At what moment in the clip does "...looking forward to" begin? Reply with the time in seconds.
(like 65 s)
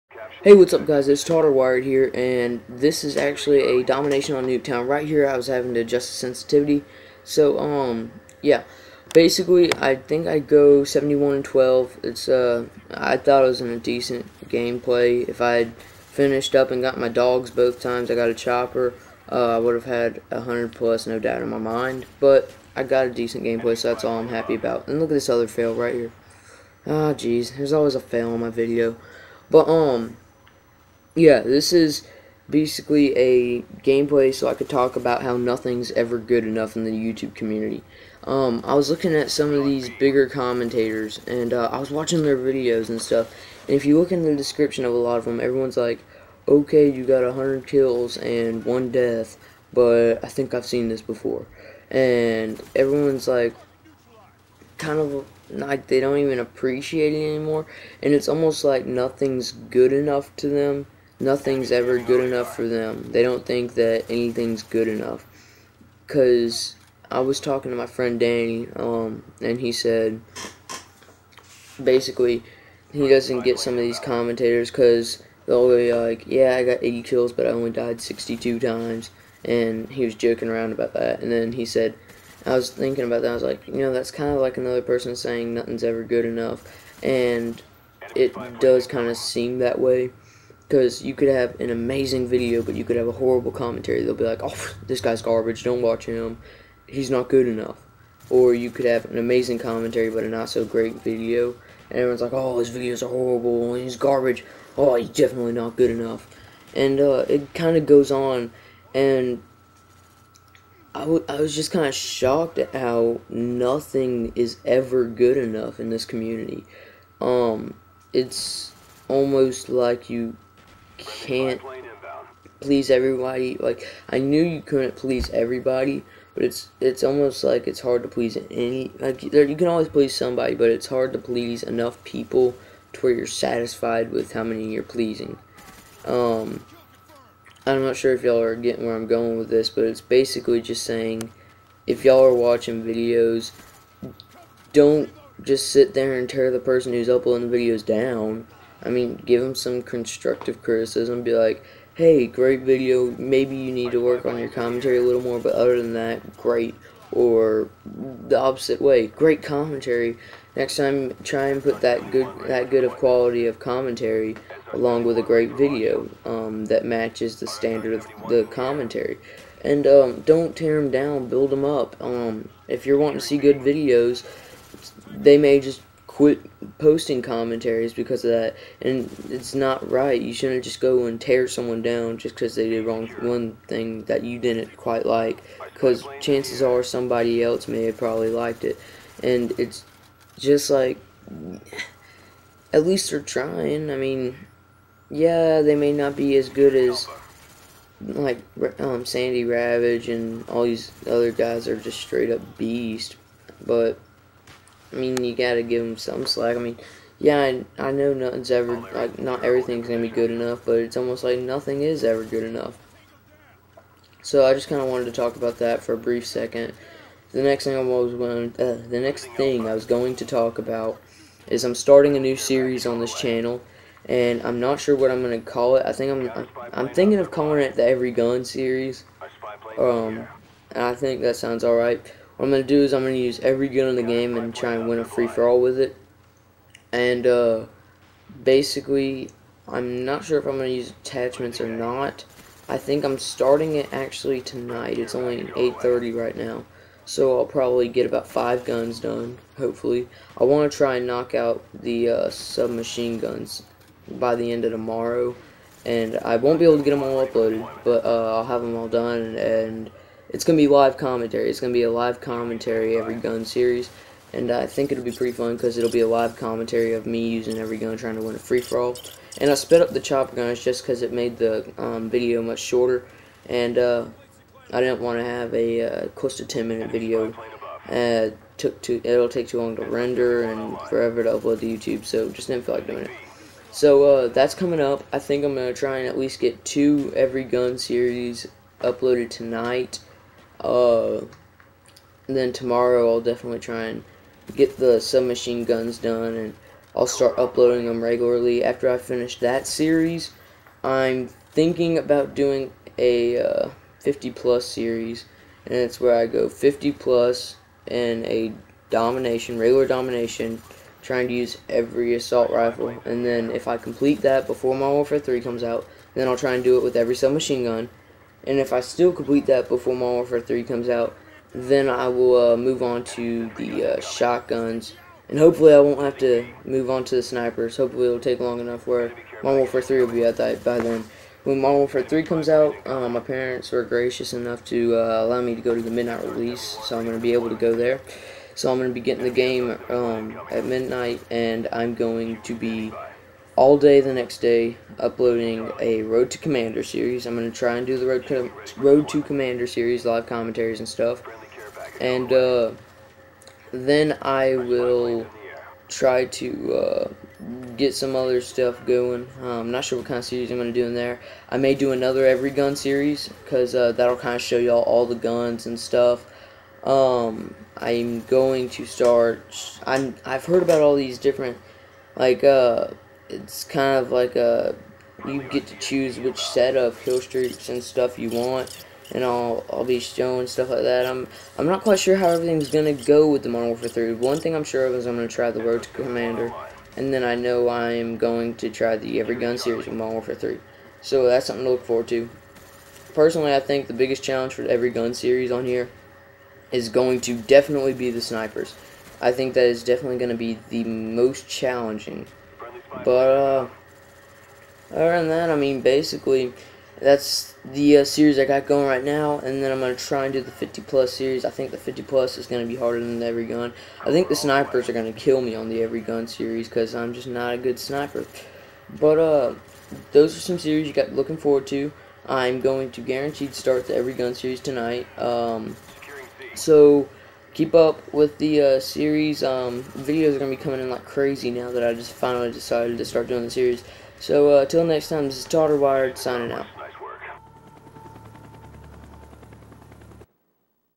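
421 s.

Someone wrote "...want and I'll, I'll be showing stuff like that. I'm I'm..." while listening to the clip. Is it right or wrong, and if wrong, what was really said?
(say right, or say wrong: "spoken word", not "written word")
right.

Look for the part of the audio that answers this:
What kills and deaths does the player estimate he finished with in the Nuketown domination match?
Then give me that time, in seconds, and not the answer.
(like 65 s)
10 s.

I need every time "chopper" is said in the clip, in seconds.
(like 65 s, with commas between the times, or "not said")
18 s, 269 s.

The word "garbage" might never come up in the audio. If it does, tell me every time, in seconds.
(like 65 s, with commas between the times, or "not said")
95 s, 103 s.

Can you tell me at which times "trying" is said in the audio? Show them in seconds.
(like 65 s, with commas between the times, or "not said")
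193 s, 267 s, 311 s.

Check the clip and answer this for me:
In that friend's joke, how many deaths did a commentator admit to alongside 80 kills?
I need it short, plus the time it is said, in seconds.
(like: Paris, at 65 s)
62, at 78 s.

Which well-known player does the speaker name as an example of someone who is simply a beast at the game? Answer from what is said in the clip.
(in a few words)
Sandy Ravage.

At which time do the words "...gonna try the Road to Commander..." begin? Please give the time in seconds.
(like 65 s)
385 s.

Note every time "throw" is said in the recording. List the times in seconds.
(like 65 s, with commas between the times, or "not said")
not said.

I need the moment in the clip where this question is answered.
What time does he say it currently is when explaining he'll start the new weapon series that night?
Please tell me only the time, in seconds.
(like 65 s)
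245 s.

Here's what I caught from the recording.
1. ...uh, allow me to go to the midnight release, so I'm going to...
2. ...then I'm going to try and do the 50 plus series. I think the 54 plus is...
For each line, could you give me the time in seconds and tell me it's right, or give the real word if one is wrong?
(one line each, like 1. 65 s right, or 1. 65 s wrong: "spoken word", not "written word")
1. 334 s right
2. 409 s wrong: "50", not "54".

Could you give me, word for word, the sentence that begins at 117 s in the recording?
Um, it's almost like you can't please everybody.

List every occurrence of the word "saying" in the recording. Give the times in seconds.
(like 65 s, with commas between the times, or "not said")
85 s, 140 s.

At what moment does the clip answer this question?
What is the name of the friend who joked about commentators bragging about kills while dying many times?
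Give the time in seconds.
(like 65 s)
68 s.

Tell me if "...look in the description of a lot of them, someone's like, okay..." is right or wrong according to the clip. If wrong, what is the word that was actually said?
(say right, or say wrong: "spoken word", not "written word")
wrong: "everyone", not "someone".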